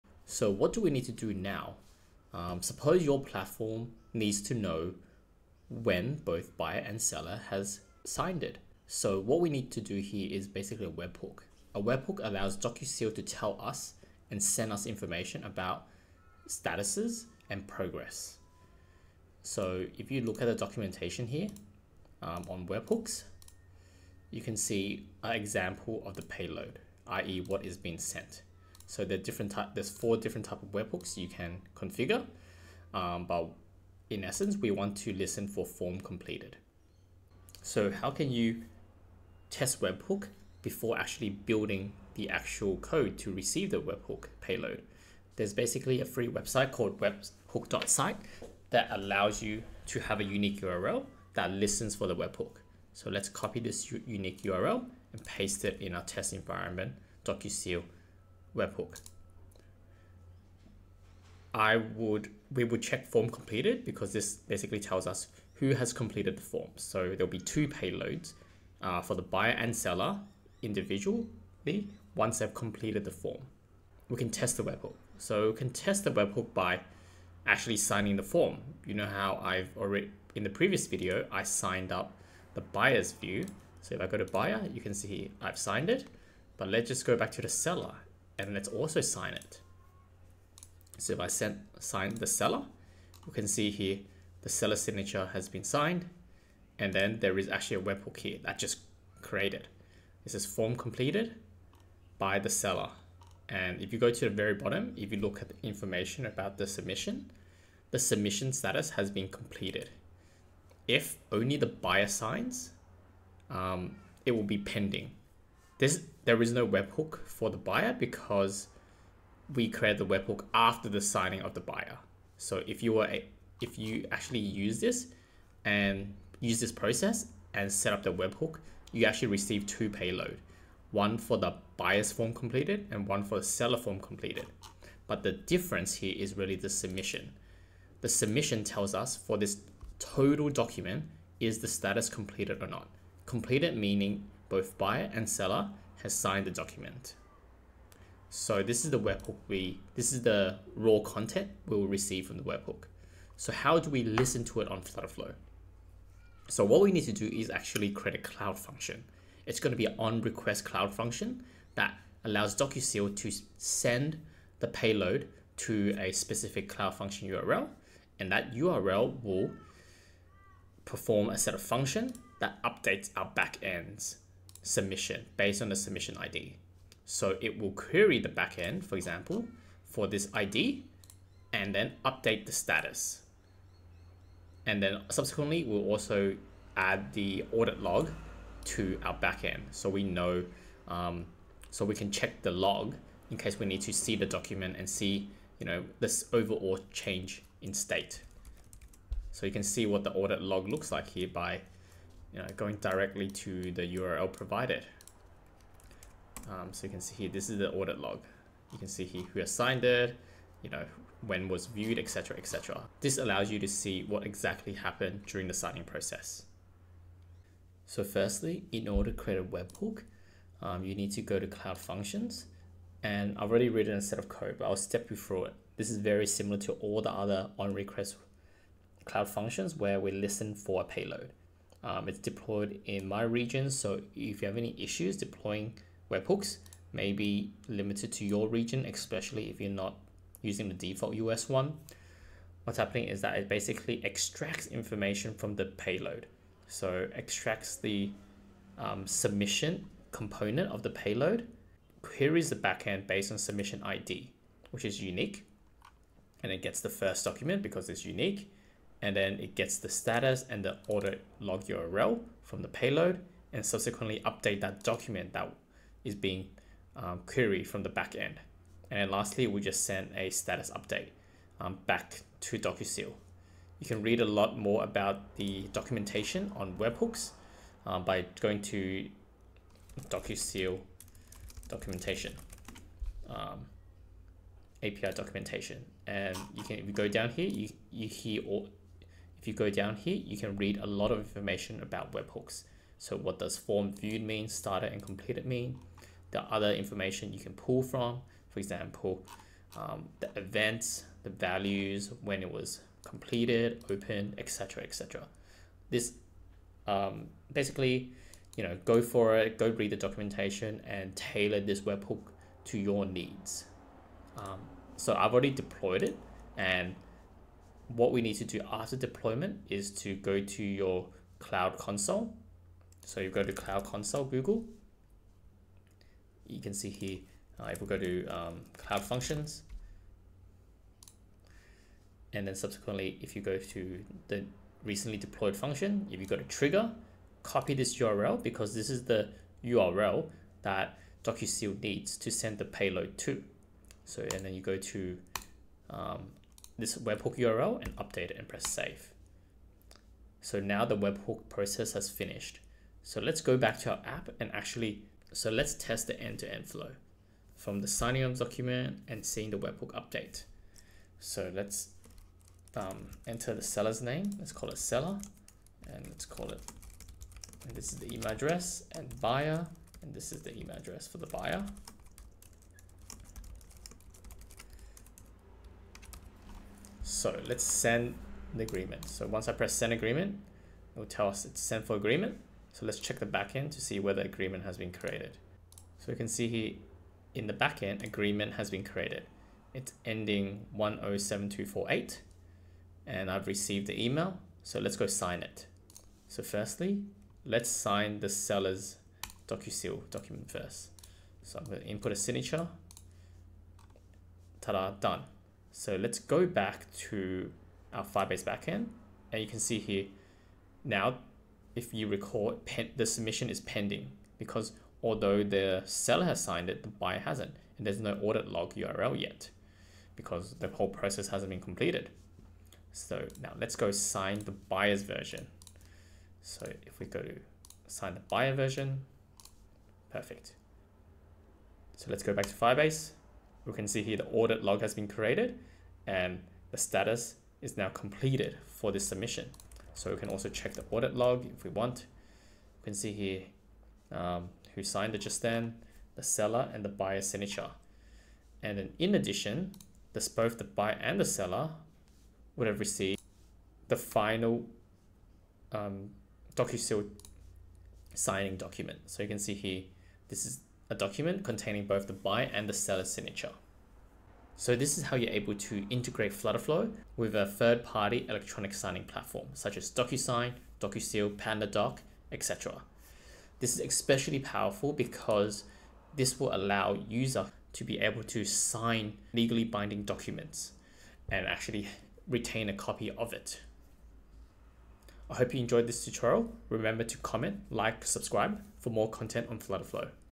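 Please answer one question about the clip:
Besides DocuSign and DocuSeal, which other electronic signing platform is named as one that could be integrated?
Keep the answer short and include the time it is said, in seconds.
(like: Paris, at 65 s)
PandaDoc, at 471 s.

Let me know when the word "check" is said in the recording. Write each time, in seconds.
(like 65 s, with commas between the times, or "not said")
62 s, 192 s, 382 s, 440 s.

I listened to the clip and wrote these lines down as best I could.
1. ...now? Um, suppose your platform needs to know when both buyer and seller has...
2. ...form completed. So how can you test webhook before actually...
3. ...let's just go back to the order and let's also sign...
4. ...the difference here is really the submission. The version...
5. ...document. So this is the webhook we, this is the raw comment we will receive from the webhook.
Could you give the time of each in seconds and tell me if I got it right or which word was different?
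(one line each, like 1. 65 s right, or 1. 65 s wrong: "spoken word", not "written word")
1. 1 s right
2. 35 s right
3. 86 s wrong: "seller", not "order"
4. 135 s wrong: "submission", not "version"
5. 146 s wrong: "content", not "comment".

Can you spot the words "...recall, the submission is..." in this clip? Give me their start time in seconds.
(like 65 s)
412 s.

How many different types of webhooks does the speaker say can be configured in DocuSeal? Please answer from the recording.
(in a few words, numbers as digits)
4.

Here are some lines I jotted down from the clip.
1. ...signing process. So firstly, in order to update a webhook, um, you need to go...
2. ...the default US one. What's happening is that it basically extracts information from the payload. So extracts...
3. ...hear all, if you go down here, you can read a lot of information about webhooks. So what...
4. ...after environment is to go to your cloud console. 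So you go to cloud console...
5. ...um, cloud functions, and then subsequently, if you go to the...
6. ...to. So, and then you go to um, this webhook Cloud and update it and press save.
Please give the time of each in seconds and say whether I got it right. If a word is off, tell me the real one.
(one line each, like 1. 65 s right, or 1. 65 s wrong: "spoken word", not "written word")
1. 215 s wrong: "create", not "update"
2. 240 s right
3. 288 s right
4. 318 s wrong: "deployment", not "environment"
5. 328 s right
6. 343 s wrong: "URL", not "Cloud".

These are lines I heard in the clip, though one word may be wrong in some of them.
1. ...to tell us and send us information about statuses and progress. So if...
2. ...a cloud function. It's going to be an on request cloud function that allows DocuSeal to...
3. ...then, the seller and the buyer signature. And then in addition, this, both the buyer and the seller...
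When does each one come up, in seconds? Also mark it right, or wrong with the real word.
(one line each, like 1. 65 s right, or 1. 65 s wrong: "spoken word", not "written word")
1. 13 s right
2. 158 s right
3. 445 s right.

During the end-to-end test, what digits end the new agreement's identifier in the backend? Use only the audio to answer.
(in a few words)
107248.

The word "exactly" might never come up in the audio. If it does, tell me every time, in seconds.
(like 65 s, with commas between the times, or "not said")
214 s.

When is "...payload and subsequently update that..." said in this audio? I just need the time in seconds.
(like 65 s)
262 s.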